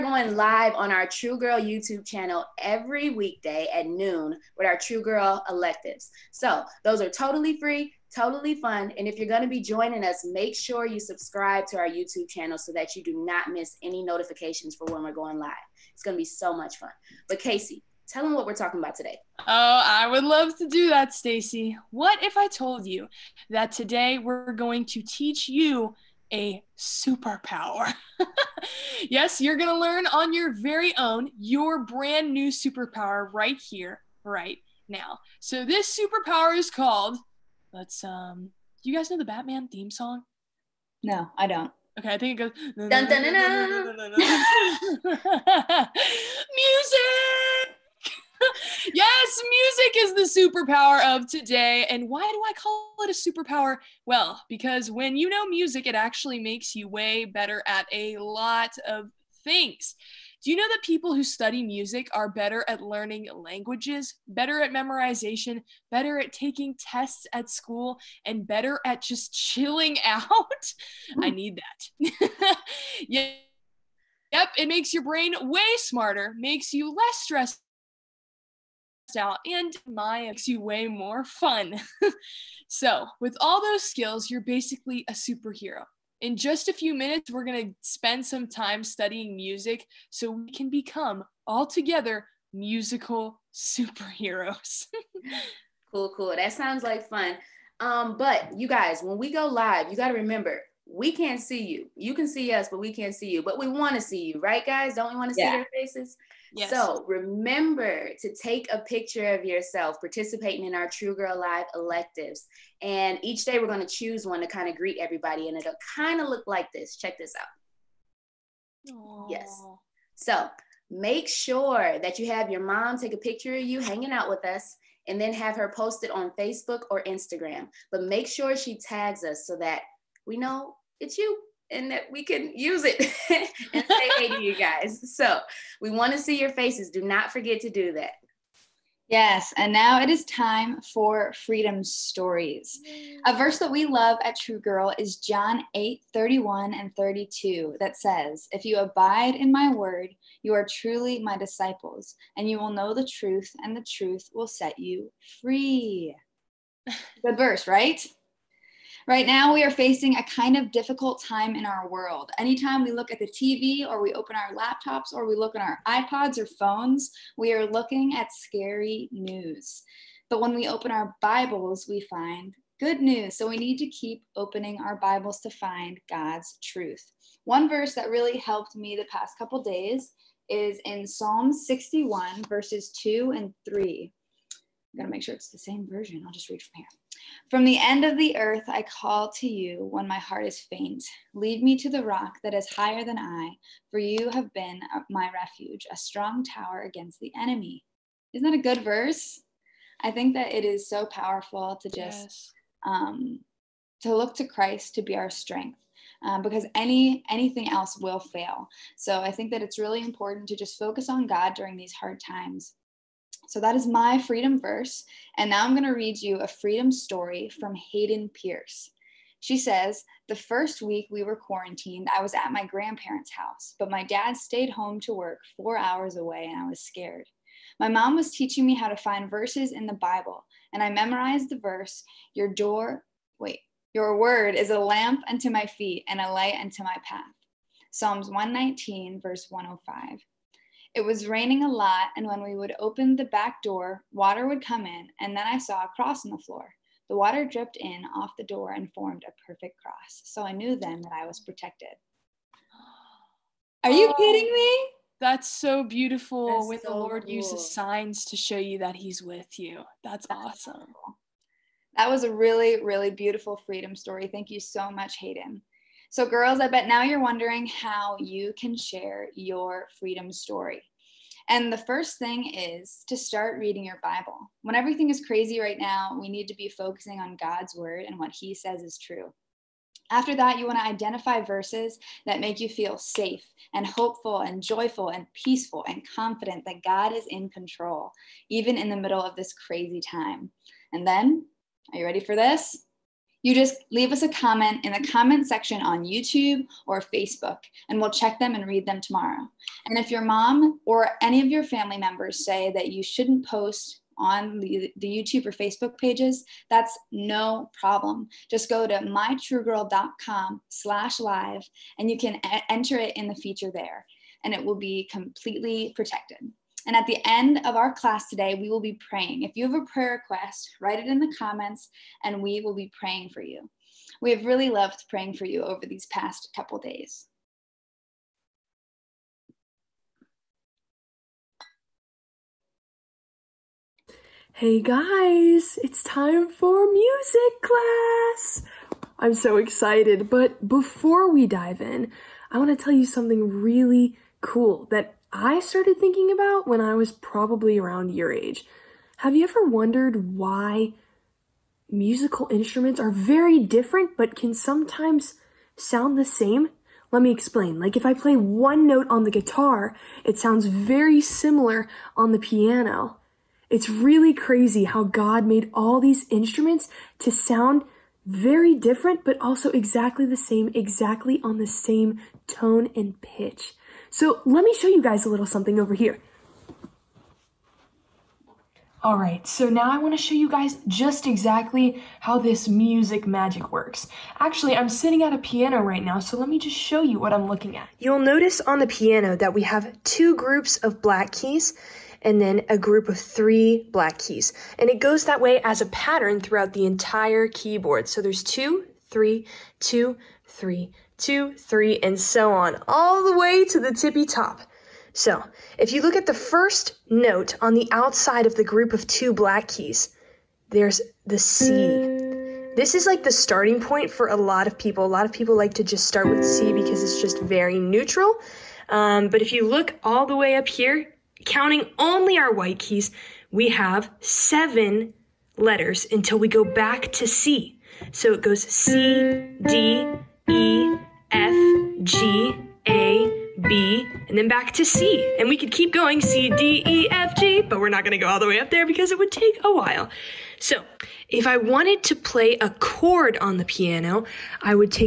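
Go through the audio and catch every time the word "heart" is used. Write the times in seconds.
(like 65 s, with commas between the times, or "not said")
190 s.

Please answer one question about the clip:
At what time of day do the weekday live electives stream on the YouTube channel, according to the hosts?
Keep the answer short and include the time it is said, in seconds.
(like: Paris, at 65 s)
noon, at 3 s.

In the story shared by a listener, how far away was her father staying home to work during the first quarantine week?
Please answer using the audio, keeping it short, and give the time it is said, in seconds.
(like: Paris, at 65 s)
4 hours, at 225 s.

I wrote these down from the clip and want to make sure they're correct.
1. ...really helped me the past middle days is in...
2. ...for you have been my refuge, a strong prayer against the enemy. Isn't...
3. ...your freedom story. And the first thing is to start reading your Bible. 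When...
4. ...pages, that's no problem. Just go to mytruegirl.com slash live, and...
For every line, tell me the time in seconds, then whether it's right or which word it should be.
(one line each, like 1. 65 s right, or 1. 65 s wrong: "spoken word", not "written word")
1. 178 s wrong: "couple", not "middle"
2. 193 s wrong: "tower", not "prayer"
3. 269 s right
4. 305 s right.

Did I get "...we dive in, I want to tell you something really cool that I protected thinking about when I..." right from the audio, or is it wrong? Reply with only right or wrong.
wrong.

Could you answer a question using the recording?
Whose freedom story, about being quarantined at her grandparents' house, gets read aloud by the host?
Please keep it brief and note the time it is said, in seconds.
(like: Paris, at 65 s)
Hayden Pierce, at 217 s.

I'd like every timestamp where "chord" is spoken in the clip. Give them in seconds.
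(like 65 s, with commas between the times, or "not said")
442 s.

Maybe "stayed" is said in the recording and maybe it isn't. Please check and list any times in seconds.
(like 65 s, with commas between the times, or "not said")
224 s.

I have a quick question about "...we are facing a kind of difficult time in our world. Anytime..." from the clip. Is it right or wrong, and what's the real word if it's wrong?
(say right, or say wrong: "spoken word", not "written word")
right.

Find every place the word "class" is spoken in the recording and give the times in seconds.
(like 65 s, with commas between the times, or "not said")
317 s, 337 s.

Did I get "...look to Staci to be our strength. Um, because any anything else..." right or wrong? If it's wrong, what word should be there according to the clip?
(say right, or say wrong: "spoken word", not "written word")
wrong: "Christ", not "Staci".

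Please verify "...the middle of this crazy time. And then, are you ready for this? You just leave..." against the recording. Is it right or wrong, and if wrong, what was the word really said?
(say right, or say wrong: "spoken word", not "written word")
right.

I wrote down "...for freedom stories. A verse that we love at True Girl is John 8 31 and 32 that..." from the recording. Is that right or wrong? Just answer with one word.
right.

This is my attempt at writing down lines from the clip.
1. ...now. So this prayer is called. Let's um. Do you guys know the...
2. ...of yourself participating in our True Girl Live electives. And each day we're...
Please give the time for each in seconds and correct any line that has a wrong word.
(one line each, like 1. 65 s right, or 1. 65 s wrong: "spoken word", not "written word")
1. 34 s wrong: "superpower", not "prayer"
2. 109 s right.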